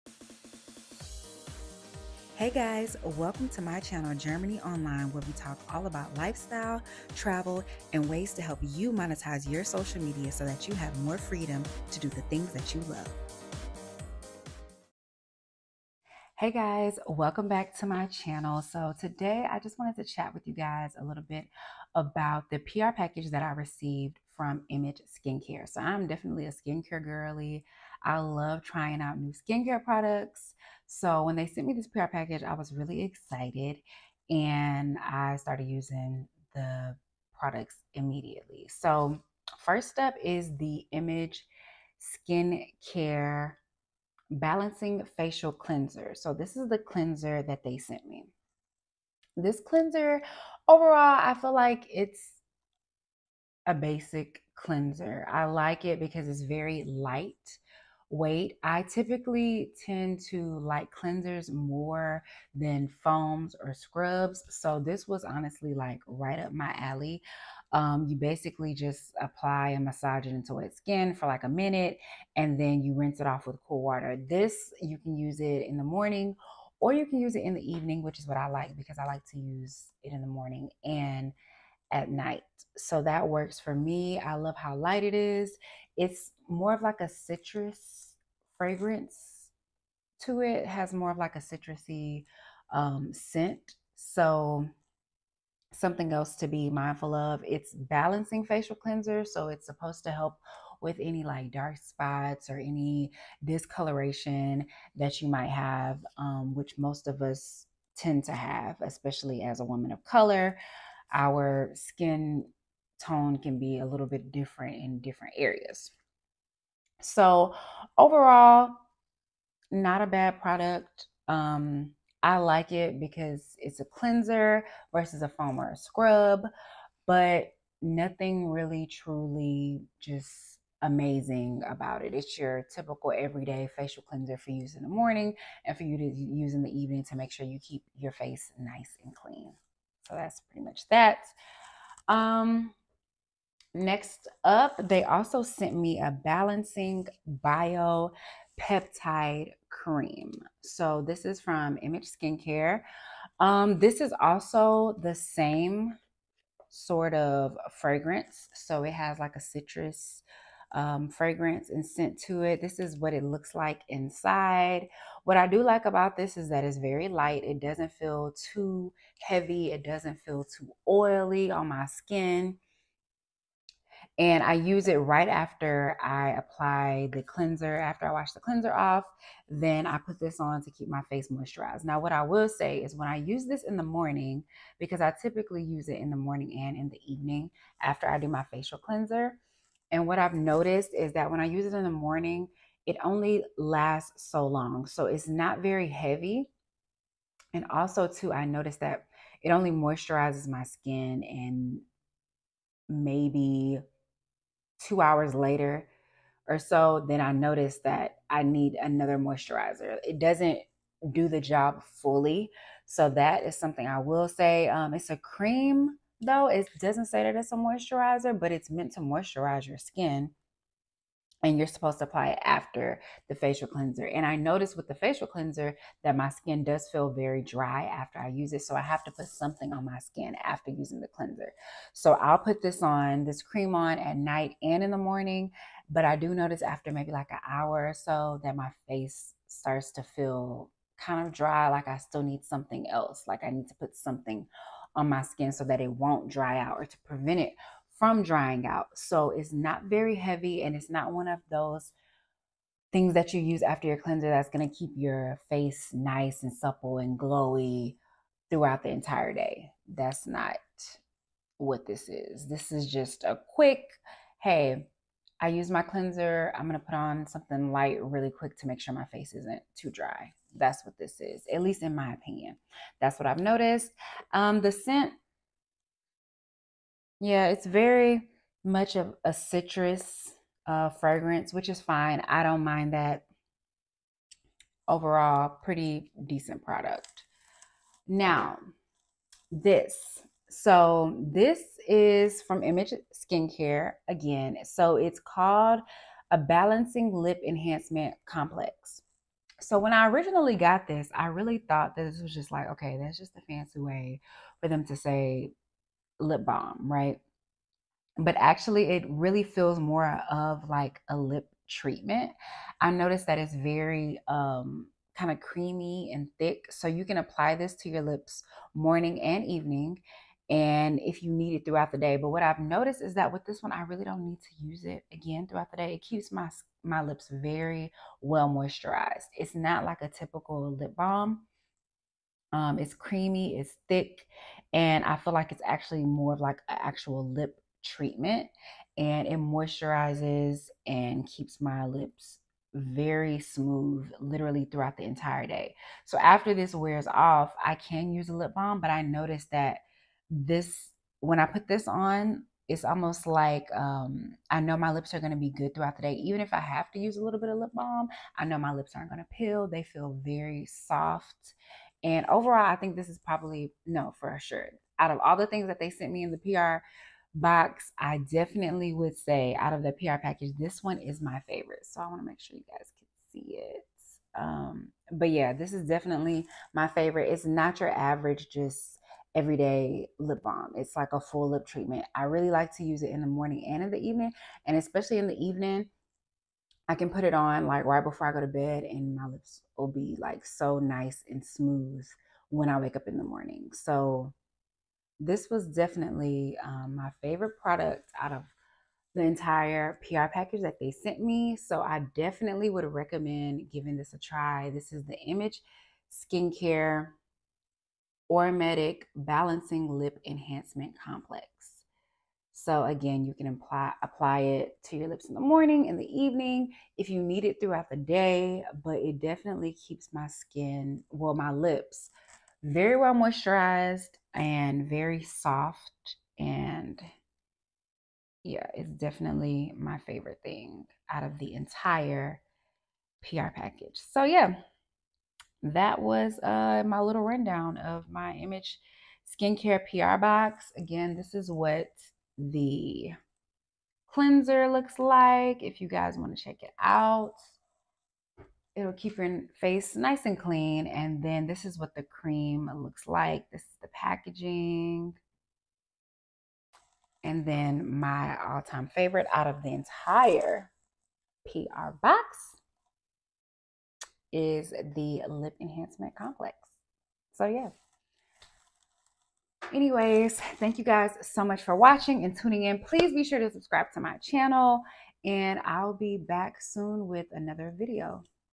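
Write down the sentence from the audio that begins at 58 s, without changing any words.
I typically tend to like cleansers more than foams or scrubs.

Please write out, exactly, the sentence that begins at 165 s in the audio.
What I do like about this is that it's very light.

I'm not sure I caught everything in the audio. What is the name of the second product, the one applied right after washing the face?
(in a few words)
balancing bio peptide cream.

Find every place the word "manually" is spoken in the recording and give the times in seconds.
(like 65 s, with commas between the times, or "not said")
not said.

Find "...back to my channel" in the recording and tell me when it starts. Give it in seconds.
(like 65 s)
17 s.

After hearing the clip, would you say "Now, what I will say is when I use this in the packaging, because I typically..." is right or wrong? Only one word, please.
wrong.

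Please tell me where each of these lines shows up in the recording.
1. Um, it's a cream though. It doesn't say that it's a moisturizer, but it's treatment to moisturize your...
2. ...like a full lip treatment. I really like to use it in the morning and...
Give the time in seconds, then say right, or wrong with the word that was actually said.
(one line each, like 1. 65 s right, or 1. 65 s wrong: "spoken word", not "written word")
1. 214 s wrong: "meant", not "treatment"
2. 380 s right.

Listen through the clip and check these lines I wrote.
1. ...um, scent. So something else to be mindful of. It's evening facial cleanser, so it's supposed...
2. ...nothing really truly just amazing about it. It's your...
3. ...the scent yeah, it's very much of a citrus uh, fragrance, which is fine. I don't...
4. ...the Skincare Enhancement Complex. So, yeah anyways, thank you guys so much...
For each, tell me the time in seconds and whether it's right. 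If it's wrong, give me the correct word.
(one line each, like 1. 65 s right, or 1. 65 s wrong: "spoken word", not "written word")
1. 92 s wrong: "balancing", not "evening"
2. 127 s right
3. 274 s right
4. 464 s wrong: "Lip", not "Skincare".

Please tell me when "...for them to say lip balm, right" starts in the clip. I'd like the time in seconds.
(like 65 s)
304 s.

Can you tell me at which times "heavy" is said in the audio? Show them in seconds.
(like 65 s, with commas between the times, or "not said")
169 s, 195 s, 250 s.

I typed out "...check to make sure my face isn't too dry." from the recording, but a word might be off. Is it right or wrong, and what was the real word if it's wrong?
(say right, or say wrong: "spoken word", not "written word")
wrong: "quick", not "check".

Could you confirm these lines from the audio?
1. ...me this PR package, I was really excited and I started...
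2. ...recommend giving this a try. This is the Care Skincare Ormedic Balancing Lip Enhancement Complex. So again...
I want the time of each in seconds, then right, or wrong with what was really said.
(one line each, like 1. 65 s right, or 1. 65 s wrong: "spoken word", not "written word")
1. 31 s right
2. 402 s wrong: "Image", not "Care".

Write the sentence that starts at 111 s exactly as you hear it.
Our skin tone can be a little bit different in different areas.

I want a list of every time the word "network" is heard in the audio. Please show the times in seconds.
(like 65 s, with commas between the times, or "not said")
not said.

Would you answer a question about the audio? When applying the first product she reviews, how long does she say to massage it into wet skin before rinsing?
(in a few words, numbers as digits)
a minute.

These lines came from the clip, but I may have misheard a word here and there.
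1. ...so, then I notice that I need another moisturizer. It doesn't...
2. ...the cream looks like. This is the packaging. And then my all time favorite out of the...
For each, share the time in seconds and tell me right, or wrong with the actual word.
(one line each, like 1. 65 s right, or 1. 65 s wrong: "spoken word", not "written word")
1. 206 s right
2. 451 s right.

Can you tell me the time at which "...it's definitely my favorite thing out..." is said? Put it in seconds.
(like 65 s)
428 s.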